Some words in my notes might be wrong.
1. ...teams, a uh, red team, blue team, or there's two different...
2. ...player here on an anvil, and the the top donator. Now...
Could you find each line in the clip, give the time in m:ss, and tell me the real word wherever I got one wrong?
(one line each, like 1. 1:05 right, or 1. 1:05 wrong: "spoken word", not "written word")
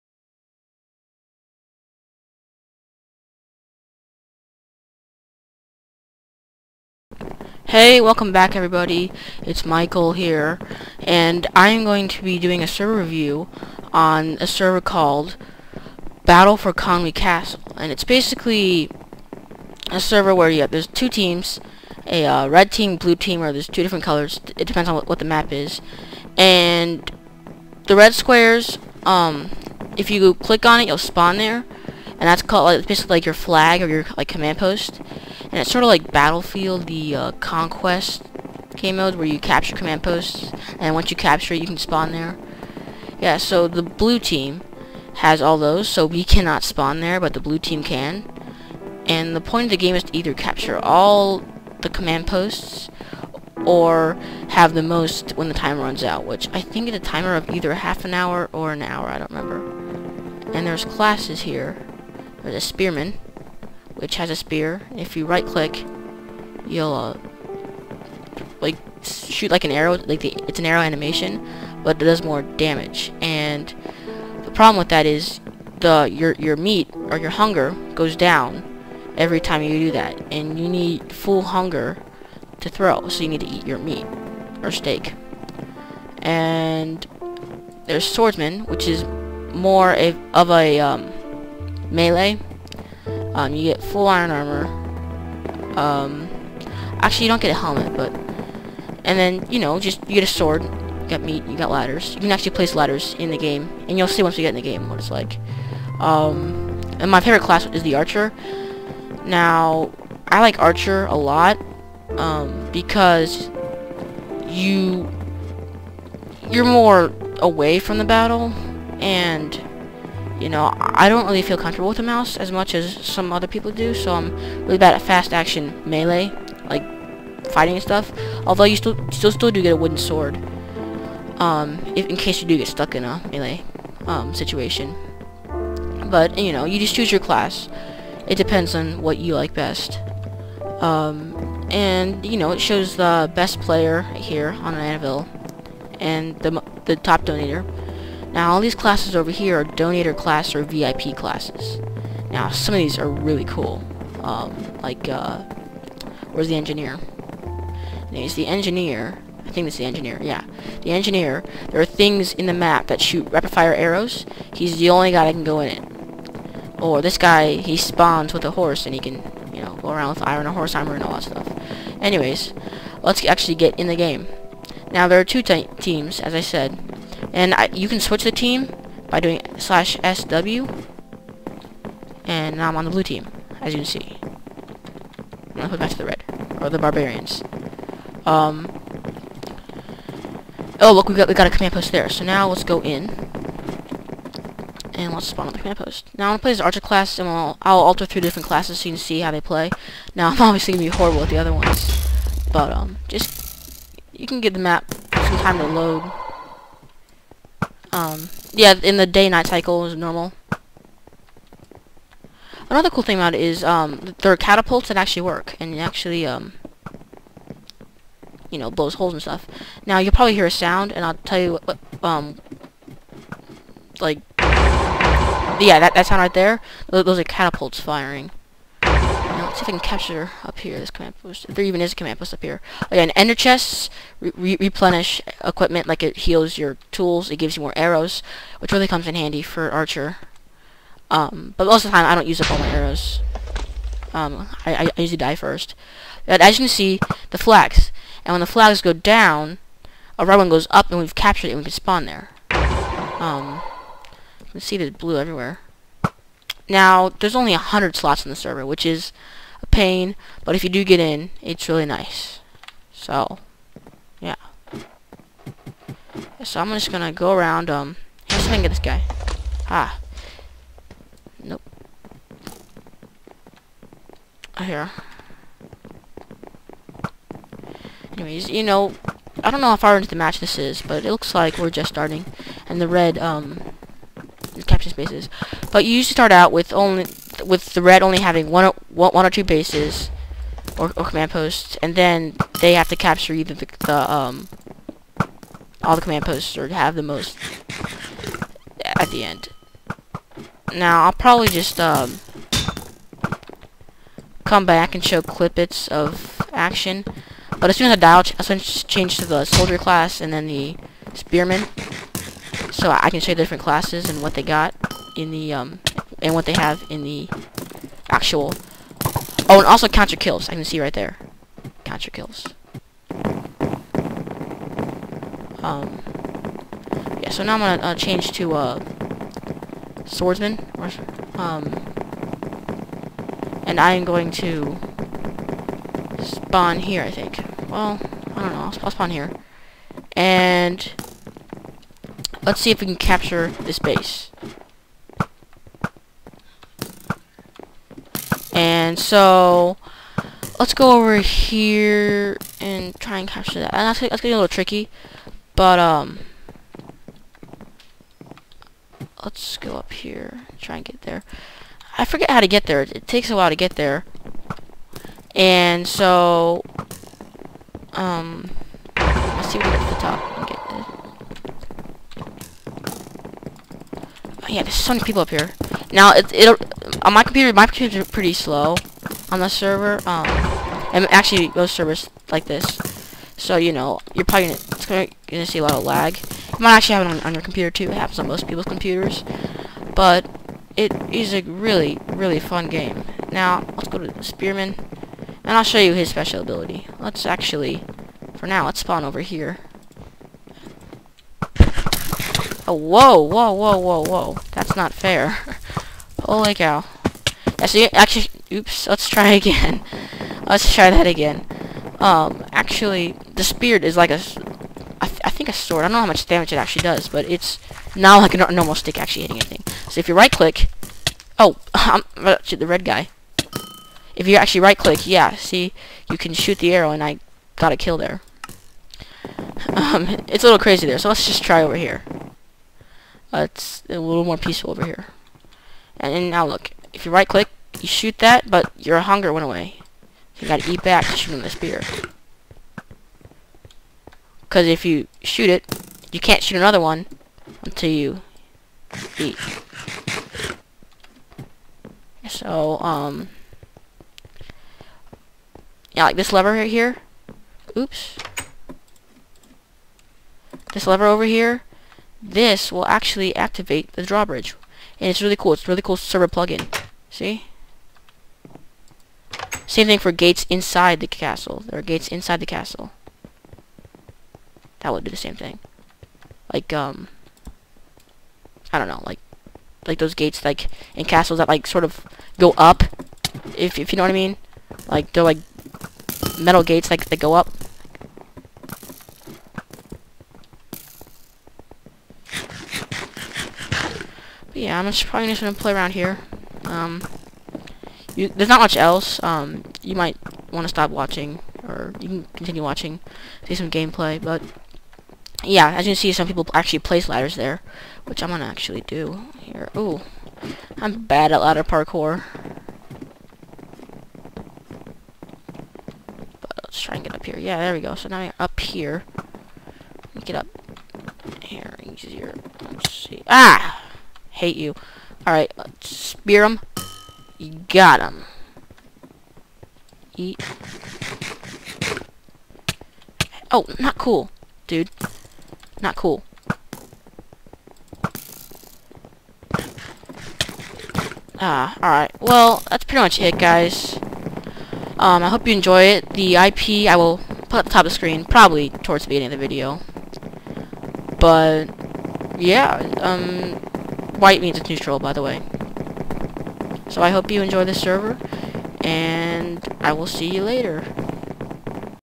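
1. 0:21 right
2. 2:23 right.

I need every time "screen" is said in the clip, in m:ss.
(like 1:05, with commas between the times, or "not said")
9:07.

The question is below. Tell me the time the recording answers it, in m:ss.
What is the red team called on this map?
3:06.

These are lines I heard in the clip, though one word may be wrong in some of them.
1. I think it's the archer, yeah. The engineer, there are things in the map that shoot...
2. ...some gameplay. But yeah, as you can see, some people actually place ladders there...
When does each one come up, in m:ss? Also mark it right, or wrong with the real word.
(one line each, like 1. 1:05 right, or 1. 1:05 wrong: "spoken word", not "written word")
1. 2:39 wrong: "engineer", not "archer"
2. 8:23 right.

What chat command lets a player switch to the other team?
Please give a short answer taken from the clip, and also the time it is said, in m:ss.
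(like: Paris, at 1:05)
/sw, at 2:59.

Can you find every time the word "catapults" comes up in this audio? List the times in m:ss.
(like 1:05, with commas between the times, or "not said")
3:34, 3:47.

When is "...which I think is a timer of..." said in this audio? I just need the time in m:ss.
0:56.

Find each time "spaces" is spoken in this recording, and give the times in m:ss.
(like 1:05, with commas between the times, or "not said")
4:44.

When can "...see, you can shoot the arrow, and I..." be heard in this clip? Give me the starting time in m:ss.
7:05.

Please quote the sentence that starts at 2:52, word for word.
Anyways, let's actually get in the game.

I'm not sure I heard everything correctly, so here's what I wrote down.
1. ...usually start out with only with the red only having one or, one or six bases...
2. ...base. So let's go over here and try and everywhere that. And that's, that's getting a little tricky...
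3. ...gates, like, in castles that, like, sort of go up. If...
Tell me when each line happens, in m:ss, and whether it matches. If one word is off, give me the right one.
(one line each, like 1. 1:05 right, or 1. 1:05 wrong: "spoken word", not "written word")
1. 4:45 wrong: "two", not "six"
2. 5:43 wrong: "capture", not "everywhere"
3. 8:00 right.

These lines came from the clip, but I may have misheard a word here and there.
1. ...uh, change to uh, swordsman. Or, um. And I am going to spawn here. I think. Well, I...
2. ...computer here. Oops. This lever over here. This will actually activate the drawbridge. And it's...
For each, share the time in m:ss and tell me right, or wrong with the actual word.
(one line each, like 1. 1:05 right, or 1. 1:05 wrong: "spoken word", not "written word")
1. 5:27 right
2. 7:36 wrong: "lever", not "computer".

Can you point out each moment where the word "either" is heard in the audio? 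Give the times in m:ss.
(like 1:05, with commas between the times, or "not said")
0:50, 0:57, 4:53.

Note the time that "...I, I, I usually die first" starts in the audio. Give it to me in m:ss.
4:04.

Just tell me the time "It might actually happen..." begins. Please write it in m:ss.
6:26.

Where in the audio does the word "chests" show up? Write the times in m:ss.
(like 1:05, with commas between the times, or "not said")
3:53.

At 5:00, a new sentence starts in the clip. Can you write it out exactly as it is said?
Now I'll probably just um come back and show clippets of action.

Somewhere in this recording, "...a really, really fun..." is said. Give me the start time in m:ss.
6:31.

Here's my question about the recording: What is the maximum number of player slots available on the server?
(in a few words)
100.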